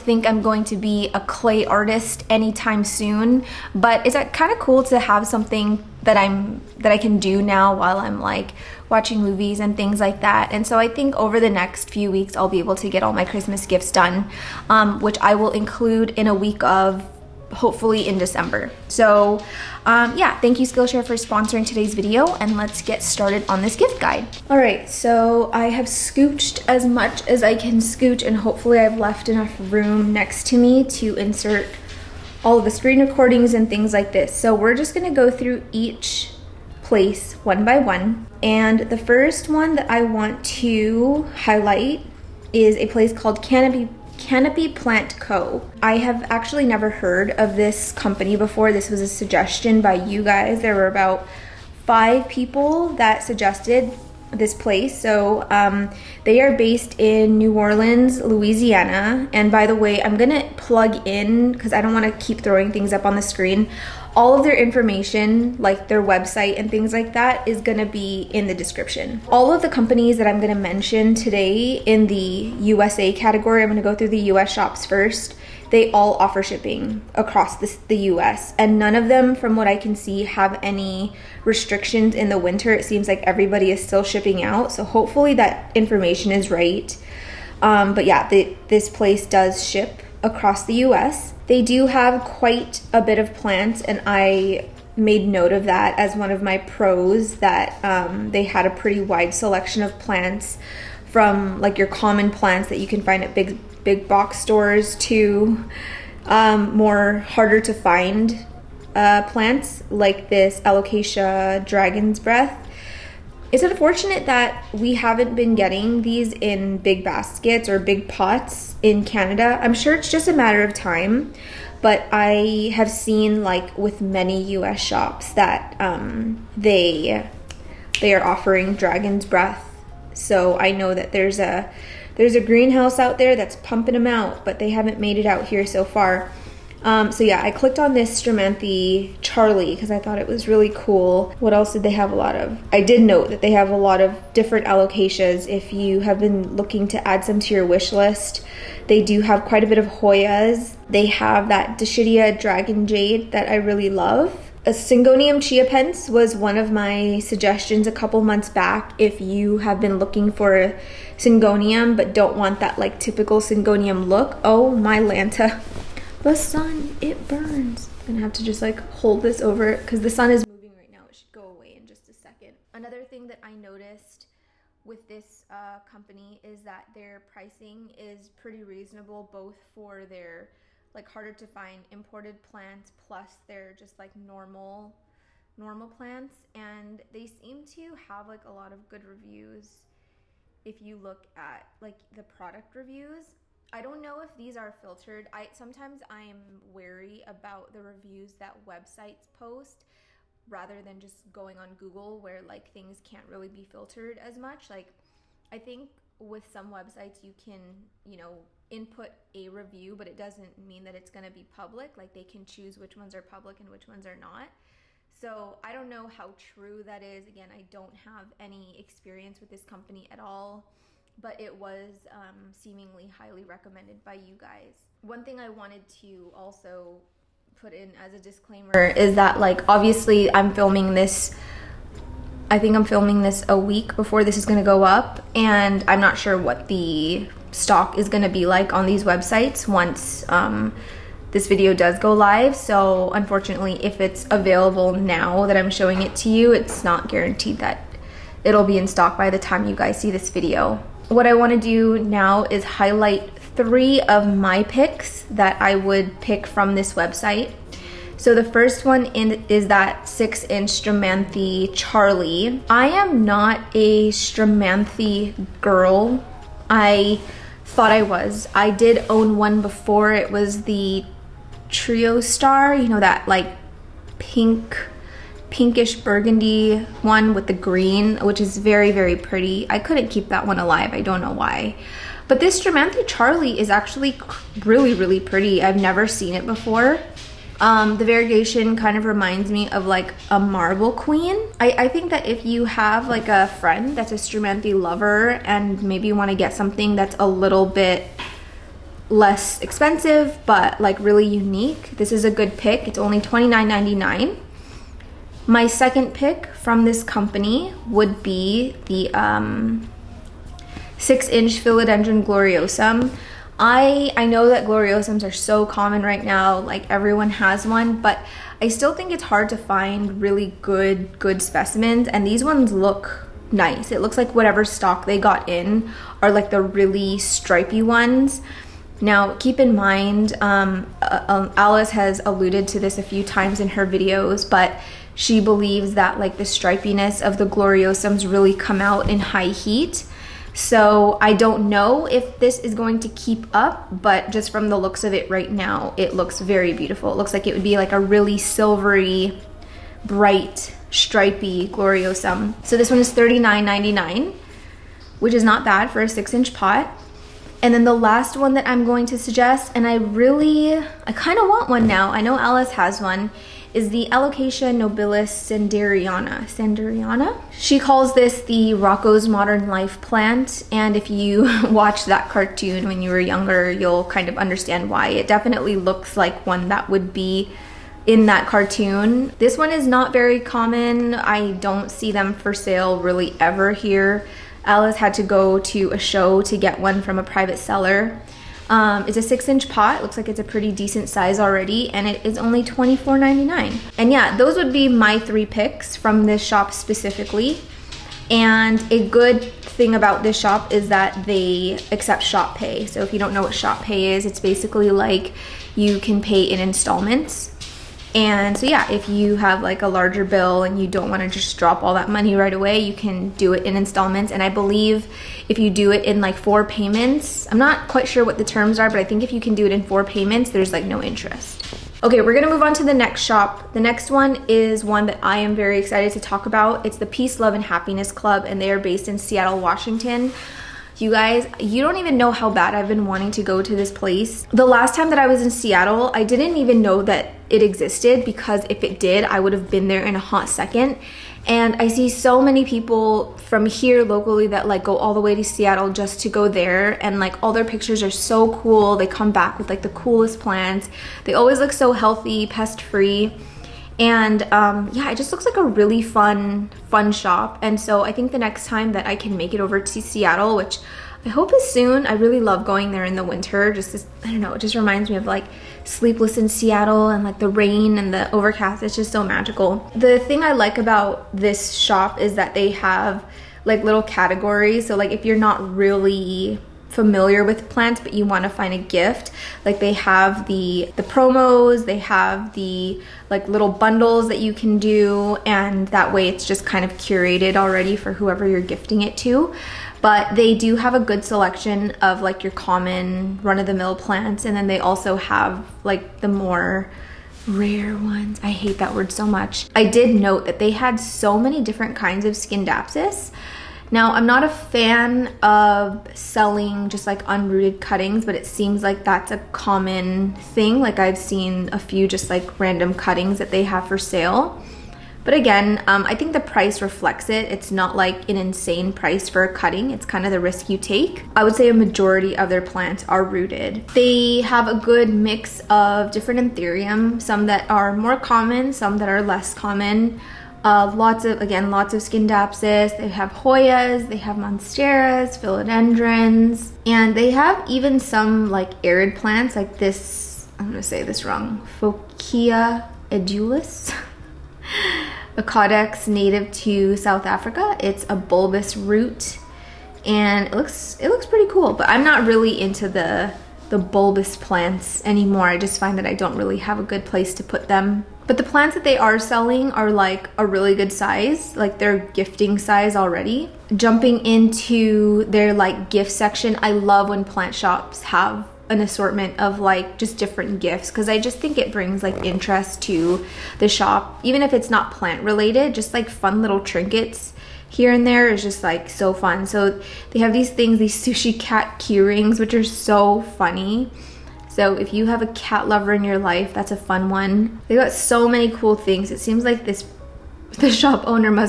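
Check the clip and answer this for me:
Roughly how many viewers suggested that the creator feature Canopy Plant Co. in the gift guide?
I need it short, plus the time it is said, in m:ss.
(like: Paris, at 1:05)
5, at 0:51.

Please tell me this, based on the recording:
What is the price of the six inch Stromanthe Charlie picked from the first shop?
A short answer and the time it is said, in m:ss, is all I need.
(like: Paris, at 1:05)
$29.99, at 5:03.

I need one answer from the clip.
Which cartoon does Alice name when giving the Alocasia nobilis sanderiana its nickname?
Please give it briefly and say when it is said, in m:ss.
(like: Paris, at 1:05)
Rocko's Modern Life, at 6:08.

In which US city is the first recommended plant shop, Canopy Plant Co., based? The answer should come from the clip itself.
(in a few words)
New Orleans.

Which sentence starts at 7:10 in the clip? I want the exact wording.
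You guys, you don't even know how bad I've been wanting to go to this place.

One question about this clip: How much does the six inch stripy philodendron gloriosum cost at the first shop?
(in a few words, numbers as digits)
$39.99.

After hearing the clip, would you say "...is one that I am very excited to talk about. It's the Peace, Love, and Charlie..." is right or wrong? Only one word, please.
wrong.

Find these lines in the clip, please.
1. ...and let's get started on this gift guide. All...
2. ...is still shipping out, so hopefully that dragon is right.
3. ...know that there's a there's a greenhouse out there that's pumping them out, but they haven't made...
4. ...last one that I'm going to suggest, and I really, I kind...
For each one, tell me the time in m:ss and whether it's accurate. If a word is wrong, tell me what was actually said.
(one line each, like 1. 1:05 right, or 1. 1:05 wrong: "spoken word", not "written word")
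1. 0:22 right
2. 1:23 wrong: "information", not "dragon"
3. 2:10 right
4. 5:57 right.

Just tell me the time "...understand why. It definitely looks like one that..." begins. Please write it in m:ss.
6:14.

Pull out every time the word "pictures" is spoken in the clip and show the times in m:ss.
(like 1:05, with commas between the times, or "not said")
7:27.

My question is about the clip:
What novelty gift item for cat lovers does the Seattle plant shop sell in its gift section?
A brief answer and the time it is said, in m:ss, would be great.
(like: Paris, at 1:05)
sushi cat key rings, at 9:40.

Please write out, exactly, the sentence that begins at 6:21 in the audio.
I don't see them for sale really ever here.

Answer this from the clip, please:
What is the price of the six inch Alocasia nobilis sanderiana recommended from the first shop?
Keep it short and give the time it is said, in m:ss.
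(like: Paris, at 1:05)
$24.99, at 6:32.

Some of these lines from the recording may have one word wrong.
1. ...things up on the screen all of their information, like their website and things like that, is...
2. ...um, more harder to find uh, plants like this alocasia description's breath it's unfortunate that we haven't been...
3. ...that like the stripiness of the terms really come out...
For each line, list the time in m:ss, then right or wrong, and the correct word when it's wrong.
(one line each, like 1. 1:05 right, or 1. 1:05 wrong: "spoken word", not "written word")
1. 1:02 right
2. 1:46 wrong: "dragon", not "description"
3. 5:35 wrong: "gloriosums", not "terms".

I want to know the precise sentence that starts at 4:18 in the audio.
So the first one in, is that six inch Stromanthe Charlie.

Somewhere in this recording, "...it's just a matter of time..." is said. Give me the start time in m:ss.
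1:59.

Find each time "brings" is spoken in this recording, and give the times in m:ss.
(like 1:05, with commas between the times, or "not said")
9:31.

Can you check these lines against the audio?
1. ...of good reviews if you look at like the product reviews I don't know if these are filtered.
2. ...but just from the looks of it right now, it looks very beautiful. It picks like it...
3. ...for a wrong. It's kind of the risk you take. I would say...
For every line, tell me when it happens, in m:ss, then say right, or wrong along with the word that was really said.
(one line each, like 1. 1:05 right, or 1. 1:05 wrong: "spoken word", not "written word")
1. 3:08 right
2. 5:43 wrong: "looks", not "picks"
3. 8:39 wrong: "cutting", not "wrong".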